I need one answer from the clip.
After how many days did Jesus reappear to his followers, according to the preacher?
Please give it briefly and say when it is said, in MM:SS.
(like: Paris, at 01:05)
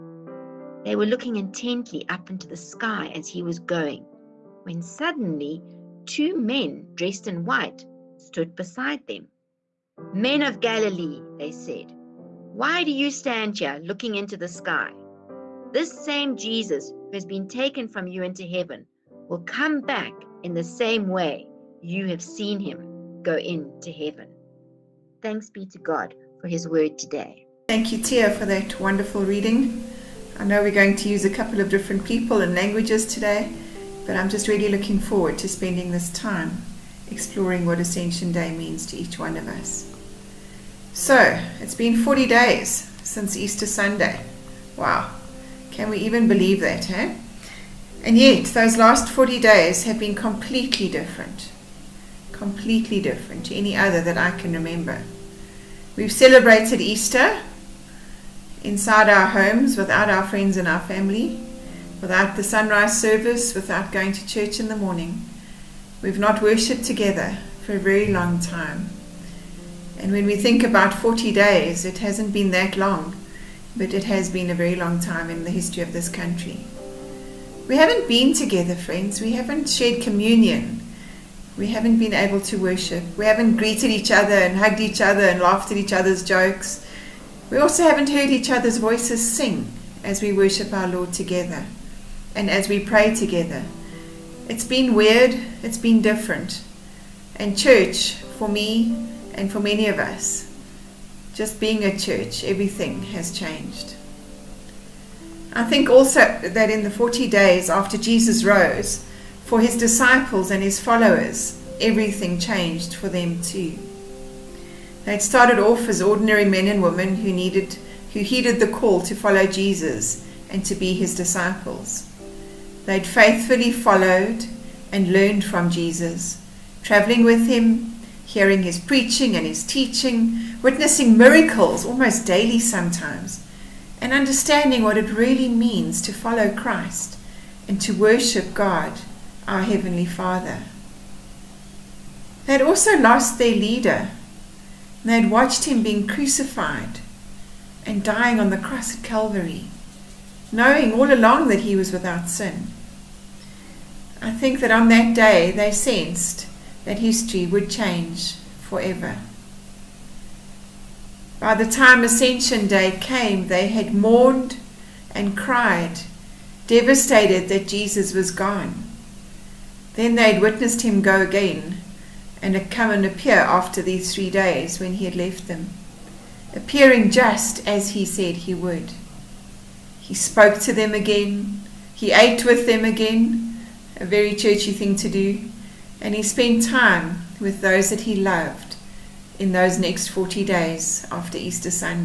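3, at 02:54.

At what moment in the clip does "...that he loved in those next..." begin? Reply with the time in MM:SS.
03:07.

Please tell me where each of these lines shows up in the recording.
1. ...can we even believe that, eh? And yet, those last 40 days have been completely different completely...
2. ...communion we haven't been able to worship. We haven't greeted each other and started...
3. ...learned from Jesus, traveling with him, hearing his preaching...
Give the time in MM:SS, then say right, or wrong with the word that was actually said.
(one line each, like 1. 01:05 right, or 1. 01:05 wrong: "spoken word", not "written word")
1. 00:45 right
2. 01:20 wrong: "hugged", not "started"
3. 02:05 right.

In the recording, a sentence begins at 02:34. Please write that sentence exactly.
I think that on that day they sensed that history would change forever.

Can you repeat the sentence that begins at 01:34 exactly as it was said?
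It's been weird, it's been different.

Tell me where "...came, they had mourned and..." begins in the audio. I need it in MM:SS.
02:42.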